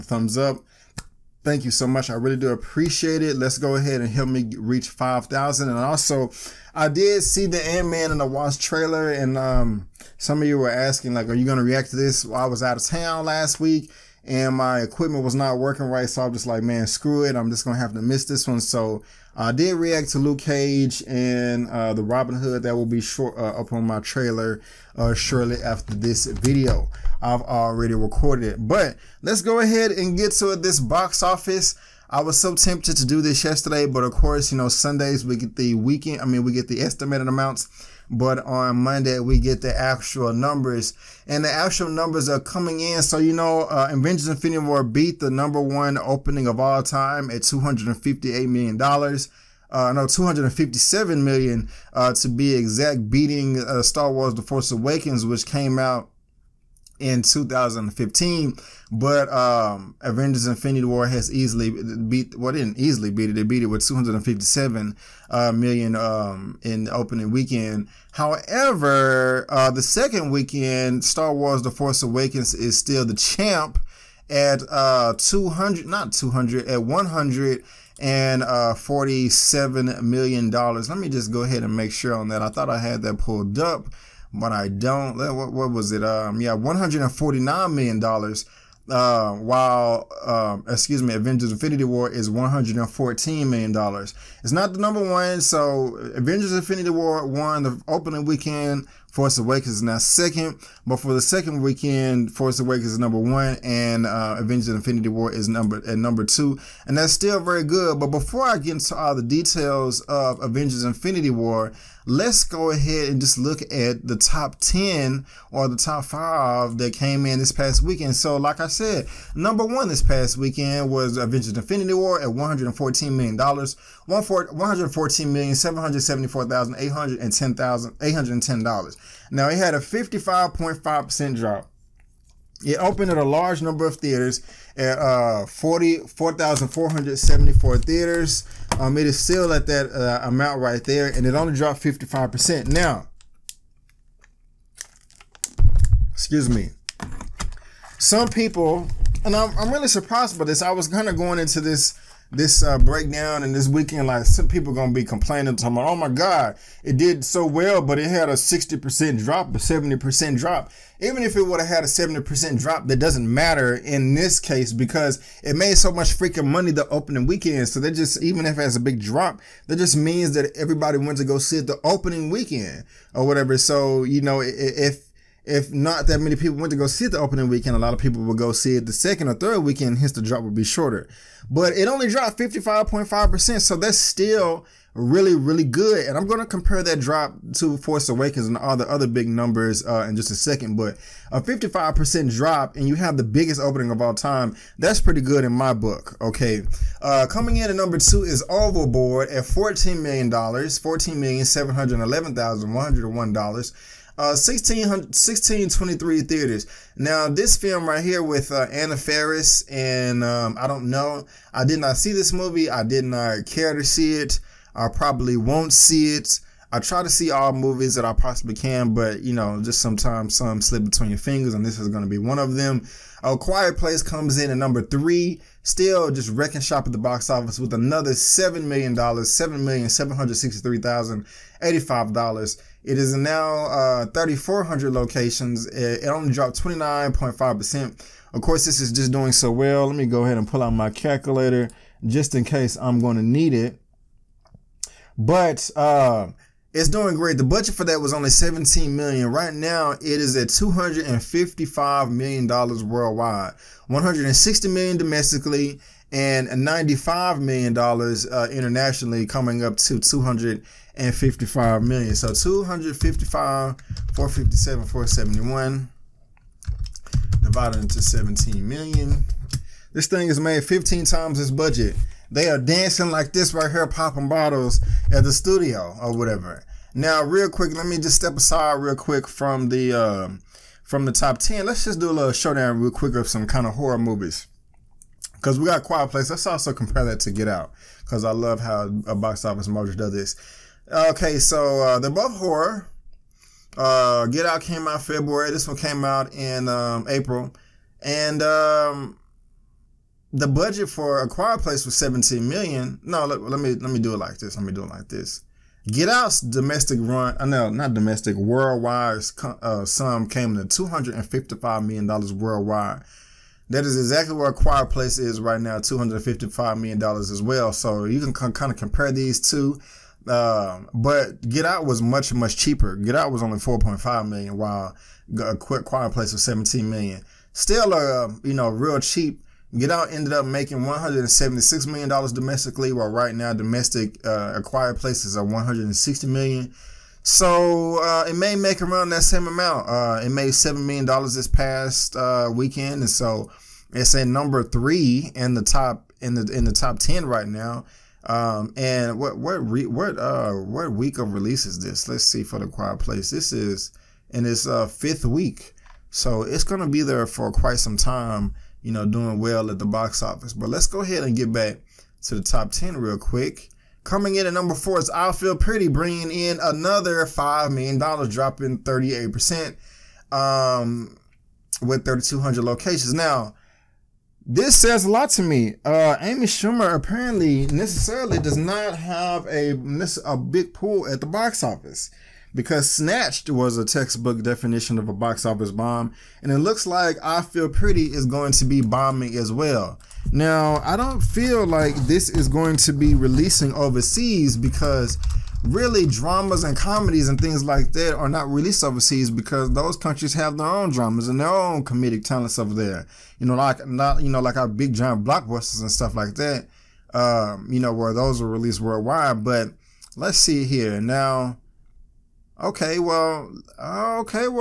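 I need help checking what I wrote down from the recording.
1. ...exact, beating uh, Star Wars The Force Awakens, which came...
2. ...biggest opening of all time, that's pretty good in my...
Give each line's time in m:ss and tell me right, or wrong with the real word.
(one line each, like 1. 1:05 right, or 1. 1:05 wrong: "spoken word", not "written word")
1. 0:52 right
2. 3:13 right.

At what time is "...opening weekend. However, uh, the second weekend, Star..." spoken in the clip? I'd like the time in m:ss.
1:06.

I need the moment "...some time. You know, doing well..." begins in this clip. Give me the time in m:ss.
5:57.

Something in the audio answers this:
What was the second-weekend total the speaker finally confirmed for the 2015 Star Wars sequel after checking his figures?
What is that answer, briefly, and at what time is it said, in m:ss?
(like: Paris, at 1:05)
$149 million, at 1:26.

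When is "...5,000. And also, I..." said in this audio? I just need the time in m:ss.
0:04.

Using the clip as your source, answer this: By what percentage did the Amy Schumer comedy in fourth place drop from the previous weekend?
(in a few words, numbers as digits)
38%.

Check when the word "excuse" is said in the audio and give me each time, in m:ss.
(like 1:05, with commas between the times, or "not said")
1:30, 2:26.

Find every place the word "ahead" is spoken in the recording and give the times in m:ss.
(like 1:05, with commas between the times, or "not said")
0:03, 0:29, 1:21, 1:52, 4:00, 6:01.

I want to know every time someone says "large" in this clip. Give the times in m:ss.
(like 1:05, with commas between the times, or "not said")
2:13.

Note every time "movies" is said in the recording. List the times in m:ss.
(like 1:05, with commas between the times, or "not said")
3:32, 3:37, 4:43.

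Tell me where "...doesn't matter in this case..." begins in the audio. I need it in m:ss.
2:42.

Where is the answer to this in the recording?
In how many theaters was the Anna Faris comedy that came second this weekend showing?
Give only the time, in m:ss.
3:24.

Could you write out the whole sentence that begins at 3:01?
But it only dropped 55.5%, so that's still really, really good.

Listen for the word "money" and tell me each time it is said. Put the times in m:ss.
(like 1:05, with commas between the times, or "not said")
2:46.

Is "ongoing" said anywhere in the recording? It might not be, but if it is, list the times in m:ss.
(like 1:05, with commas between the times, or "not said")
not said.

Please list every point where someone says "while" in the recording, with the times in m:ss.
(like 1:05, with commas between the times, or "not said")
1:29, 5:24, 5:32.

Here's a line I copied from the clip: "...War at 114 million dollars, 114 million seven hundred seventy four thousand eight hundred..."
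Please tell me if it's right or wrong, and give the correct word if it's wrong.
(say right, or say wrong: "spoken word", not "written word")
right.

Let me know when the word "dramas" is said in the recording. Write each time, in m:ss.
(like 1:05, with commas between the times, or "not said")
6:36, 6:40.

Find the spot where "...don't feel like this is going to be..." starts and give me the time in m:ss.
6:30.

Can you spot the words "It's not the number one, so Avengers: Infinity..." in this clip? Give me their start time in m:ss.
1:34.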